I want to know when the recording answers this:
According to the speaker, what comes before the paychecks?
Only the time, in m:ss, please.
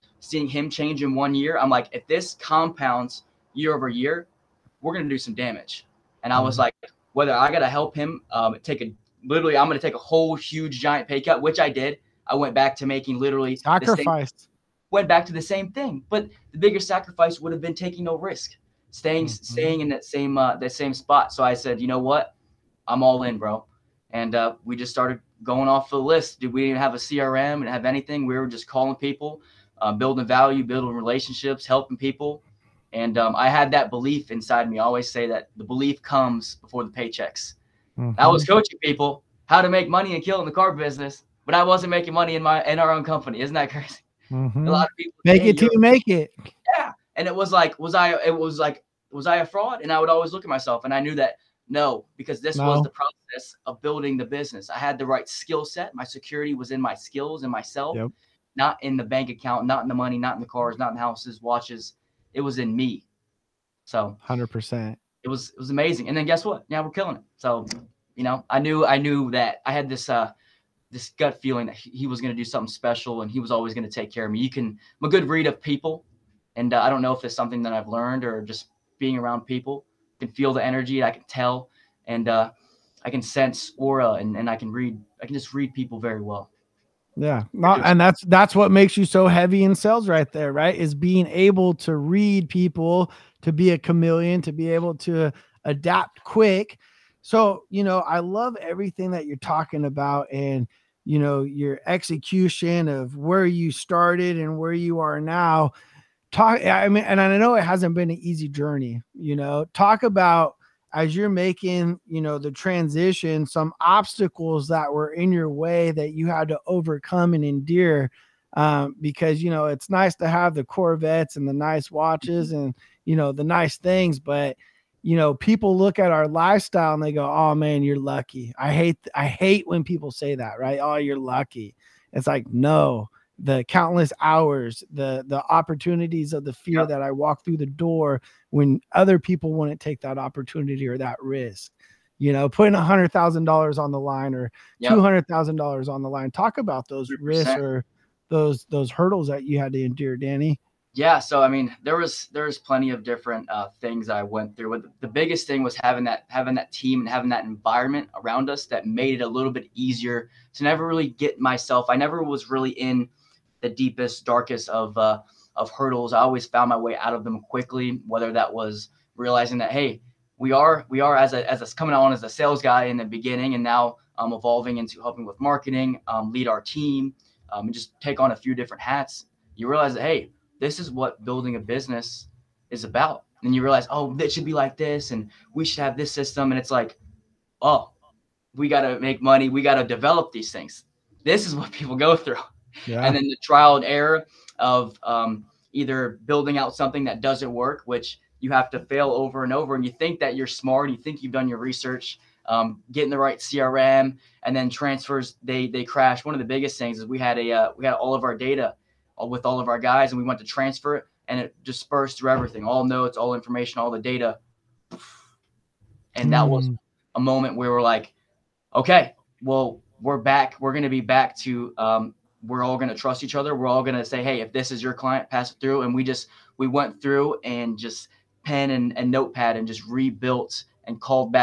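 0:35.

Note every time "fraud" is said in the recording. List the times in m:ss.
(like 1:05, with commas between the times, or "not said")
0:49.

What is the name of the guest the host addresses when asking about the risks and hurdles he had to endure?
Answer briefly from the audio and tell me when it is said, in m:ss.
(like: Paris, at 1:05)
Danny, at 2:30.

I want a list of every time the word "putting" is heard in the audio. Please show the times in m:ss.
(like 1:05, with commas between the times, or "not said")
2:22.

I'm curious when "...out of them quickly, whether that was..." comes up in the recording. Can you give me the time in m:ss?
2:46.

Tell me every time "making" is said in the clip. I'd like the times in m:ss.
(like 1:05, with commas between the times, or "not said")
0:12, 0:41, 1:51.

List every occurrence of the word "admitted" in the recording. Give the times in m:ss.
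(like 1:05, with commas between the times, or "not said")
not said.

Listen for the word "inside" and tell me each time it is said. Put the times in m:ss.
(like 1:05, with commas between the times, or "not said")
0:34.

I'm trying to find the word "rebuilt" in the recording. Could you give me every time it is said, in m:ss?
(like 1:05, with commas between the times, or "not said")
3:49.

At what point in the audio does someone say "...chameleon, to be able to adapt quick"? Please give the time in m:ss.
1:33.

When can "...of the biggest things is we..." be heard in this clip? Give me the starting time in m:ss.
3:26.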